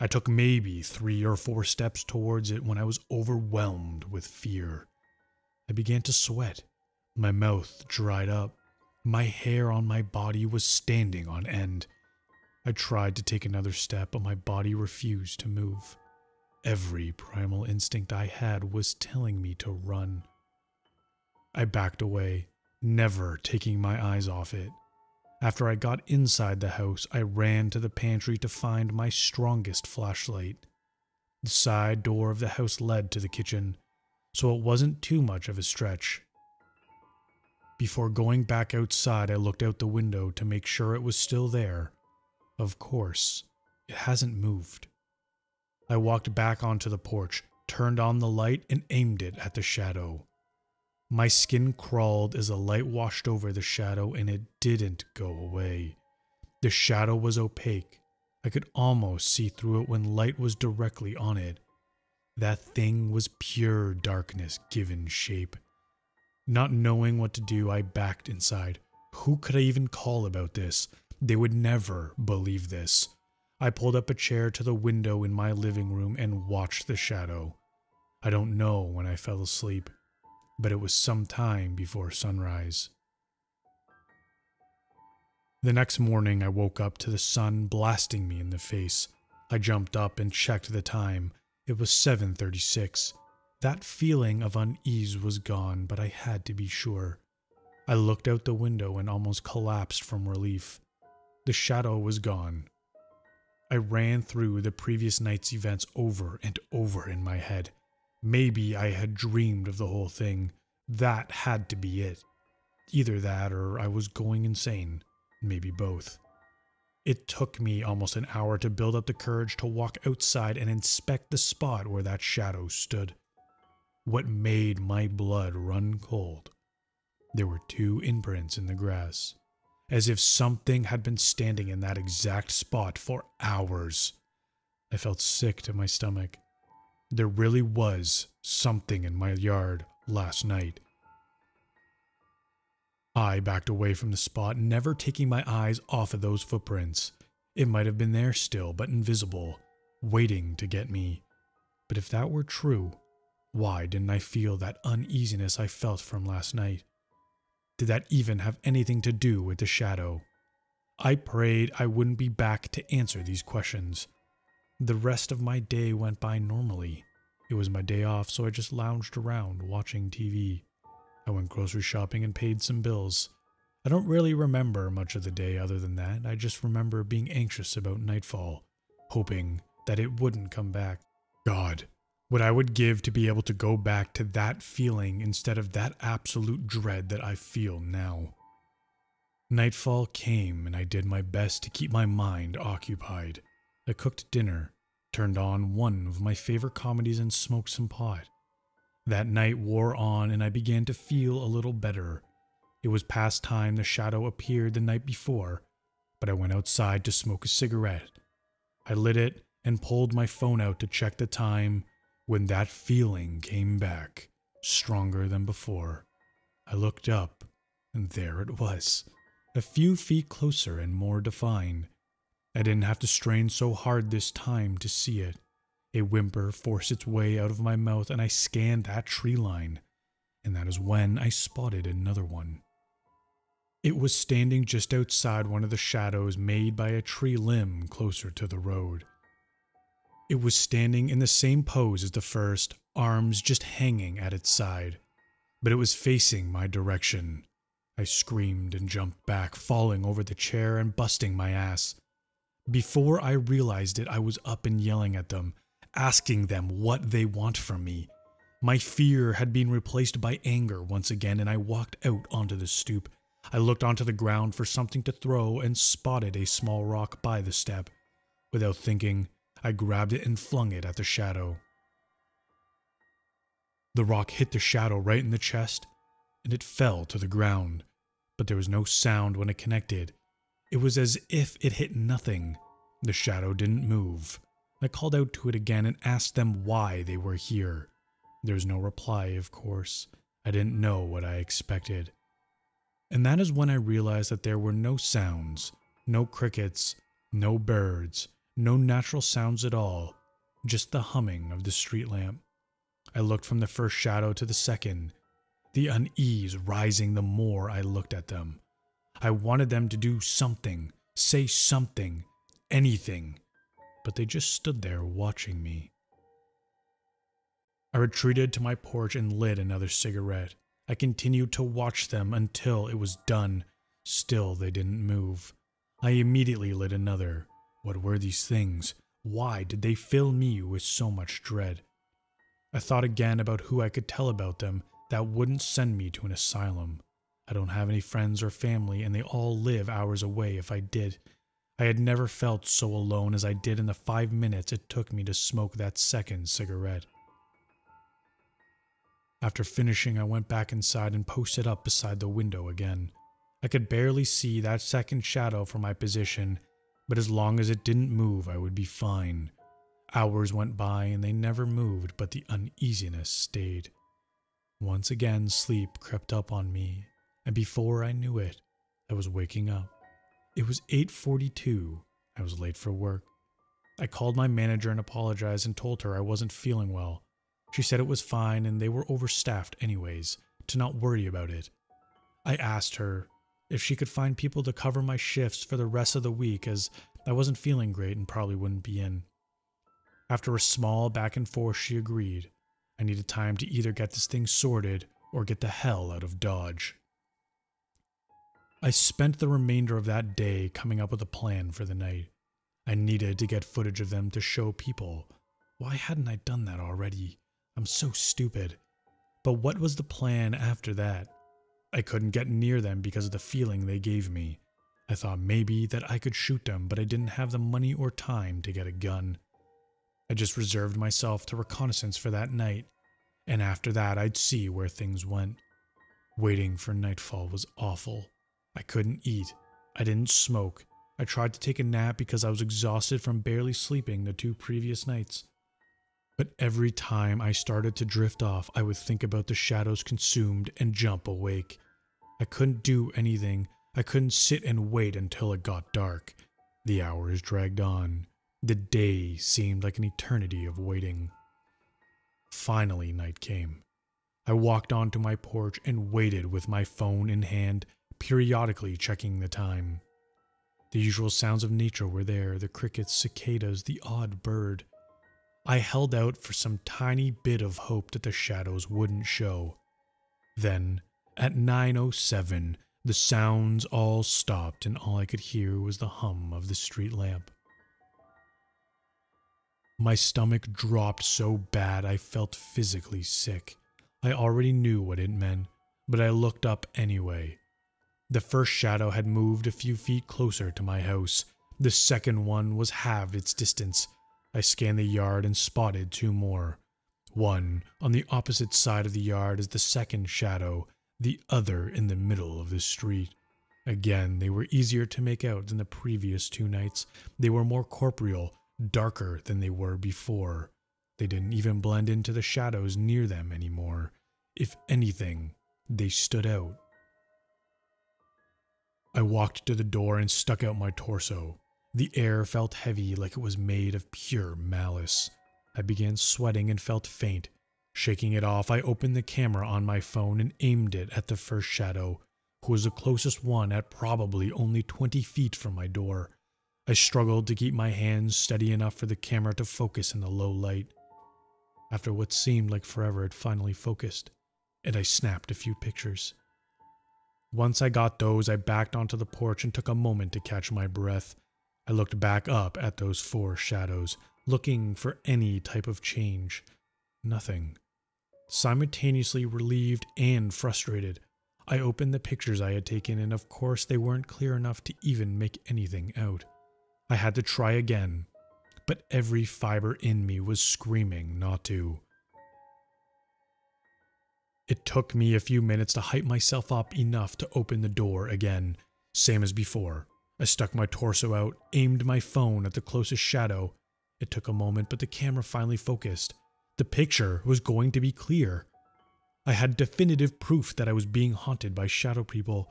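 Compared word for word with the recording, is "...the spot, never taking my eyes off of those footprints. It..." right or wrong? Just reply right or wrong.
right.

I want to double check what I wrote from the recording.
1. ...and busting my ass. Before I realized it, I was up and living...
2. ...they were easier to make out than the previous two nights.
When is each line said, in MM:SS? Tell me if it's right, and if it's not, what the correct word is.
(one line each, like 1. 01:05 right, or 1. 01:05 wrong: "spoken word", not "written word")
1. 04:10 wrong: "yelling", not "living"
2. 08:24 right.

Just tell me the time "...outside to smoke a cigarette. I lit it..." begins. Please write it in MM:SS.
03:26.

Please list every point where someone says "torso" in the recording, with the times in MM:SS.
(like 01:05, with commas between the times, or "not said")
08:40, 09:40.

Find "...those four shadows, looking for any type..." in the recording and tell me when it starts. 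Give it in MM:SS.
09:12.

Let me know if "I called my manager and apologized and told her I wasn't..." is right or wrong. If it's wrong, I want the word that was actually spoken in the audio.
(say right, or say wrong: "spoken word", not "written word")
right.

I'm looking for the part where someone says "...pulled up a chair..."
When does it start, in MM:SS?
01:13.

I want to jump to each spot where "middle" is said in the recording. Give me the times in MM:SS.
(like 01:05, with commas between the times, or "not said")
08:22.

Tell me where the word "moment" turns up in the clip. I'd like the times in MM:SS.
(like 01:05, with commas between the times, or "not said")
09:09, 09:44.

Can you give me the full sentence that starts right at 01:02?
That thing was pure darkness given shape.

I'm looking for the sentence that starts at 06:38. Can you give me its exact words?
I spent the remainder of that day coming up with a plan for the night.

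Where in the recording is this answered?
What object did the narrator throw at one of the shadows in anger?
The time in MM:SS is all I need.
04:26.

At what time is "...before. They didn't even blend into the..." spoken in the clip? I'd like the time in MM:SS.
08:29.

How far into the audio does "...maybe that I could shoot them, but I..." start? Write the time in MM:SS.
06:55.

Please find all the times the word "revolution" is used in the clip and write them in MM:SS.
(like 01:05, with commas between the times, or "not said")
not said.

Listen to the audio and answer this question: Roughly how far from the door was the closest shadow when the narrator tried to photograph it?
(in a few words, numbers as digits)
20 feet.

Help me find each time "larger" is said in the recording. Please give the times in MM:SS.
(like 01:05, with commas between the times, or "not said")
not said.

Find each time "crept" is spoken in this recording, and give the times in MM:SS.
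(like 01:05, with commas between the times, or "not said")
06:05.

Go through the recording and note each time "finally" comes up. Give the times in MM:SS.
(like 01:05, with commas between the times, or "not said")
07:32, 09:03, 09:45.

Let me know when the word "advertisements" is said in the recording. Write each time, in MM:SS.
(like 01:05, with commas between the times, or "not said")
not said.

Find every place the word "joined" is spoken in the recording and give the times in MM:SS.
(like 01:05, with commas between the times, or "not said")
not said.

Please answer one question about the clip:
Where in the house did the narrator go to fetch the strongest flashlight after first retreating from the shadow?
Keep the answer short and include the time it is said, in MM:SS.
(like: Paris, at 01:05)
the pantry, at 00:27.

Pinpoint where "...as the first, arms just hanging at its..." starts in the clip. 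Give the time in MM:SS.
04:02.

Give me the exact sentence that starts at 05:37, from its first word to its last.
I don't have any friends or family, and they all live hours away if I did.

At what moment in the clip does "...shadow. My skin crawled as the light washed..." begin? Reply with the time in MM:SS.
00:49.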